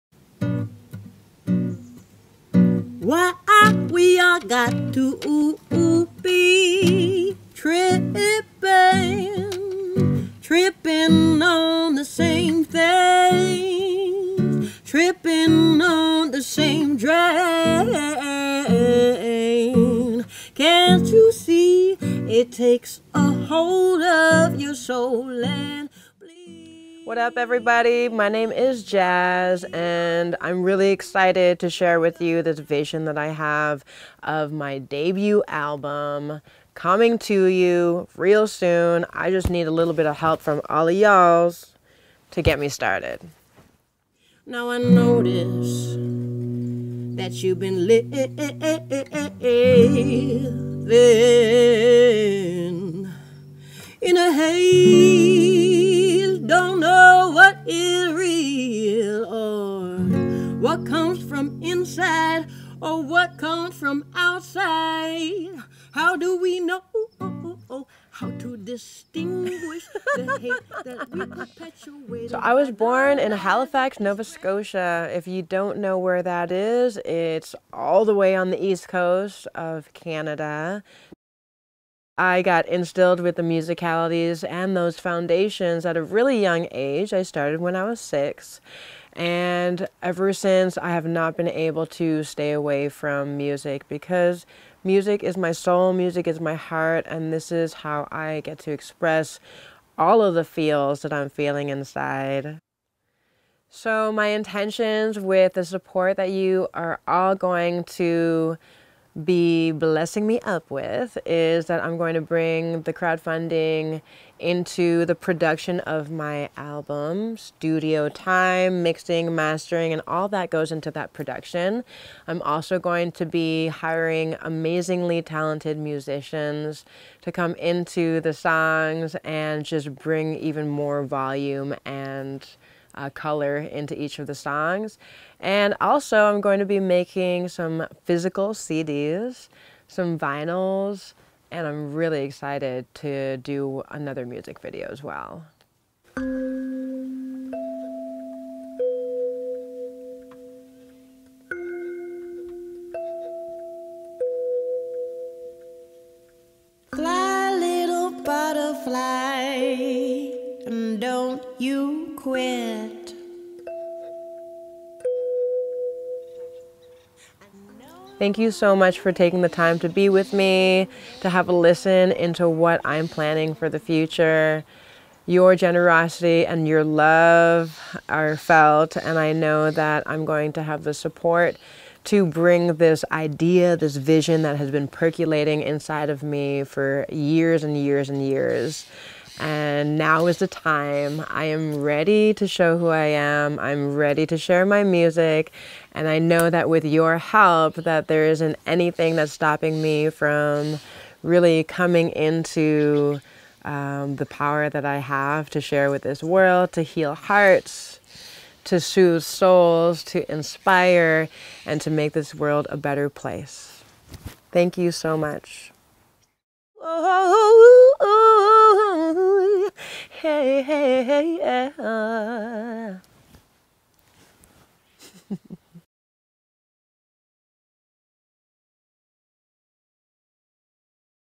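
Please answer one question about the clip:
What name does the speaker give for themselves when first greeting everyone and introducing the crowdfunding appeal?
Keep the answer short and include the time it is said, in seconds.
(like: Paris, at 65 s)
Jazz, at 28 s.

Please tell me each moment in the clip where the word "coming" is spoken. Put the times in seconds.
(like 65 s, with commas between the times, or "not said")
36 s, 201 s.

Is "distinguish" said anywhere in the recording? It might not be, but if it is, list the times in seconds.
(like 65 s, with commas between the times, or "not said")
68 s.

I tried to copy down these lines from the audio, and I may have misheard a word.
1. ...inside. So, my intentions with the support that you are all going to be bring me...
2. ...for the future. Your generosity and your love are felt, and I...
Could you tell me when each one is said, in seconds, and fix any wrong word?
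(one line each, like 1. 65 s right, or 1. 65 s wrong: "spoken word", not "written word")
1. 101 s wrong: "blessing", not "bring"
2. 173 s right.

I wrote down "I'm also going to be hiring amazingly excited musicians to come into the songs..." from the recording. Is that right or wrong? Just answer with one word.
wrong.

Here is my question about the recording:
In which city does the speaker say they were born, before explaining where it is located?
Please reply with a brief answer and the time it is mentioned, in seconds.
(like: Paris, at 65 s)
Halifax, at 73 s.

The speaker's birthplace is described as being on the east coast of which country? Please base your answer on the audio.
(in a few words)
Canada.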